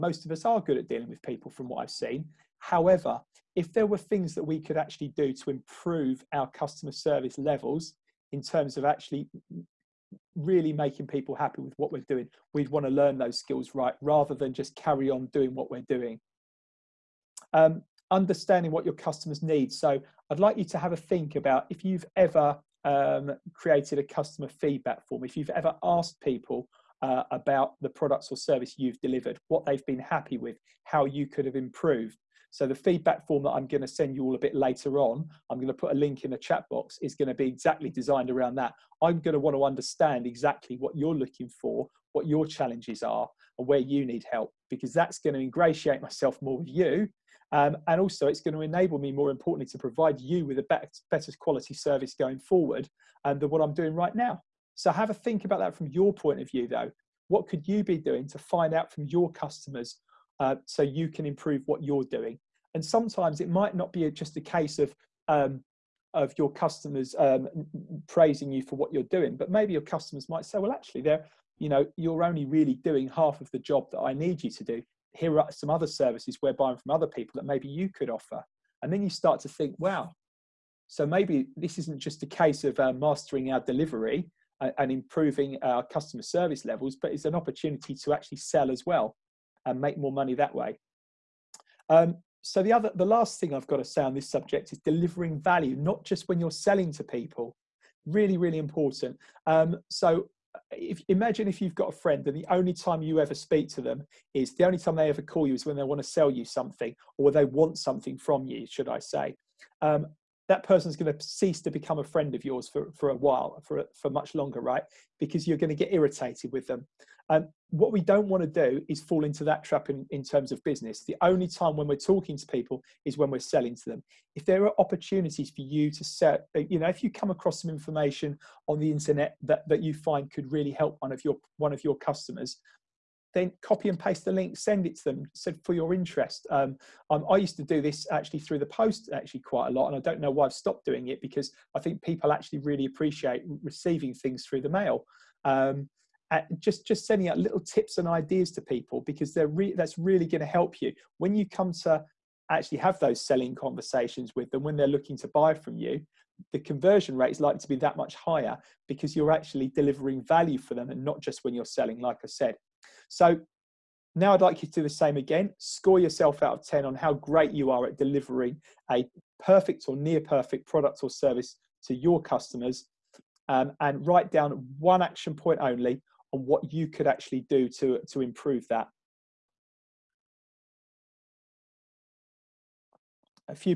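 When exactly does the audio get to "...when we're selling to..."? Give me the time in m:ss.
2:03.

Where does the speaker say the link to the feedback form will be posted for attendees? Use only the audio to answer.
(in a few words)
The chat box.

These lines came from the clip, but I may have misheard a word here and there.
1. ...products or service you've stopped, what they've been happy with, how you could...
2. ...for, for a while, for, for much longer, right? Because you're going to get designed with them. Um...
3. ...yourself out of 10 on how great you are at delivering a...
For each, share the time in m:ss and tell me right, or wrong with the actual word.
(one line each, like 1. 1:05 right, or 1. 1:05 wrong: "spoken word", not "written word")
1. 0:27 wrong: "delivered", not "stopped"
2. 1:52 wrong: "irritated", not "designed"
3. 2:45 right.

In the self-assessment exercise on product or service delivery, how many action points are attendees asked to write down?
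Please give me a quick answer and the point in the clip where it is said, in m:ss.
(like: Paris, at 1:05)
1, at 2:54.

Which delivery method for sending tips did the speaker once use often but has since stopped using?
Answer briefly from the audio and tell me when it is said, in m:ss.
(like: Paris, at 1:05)
Through the post, at 2:18.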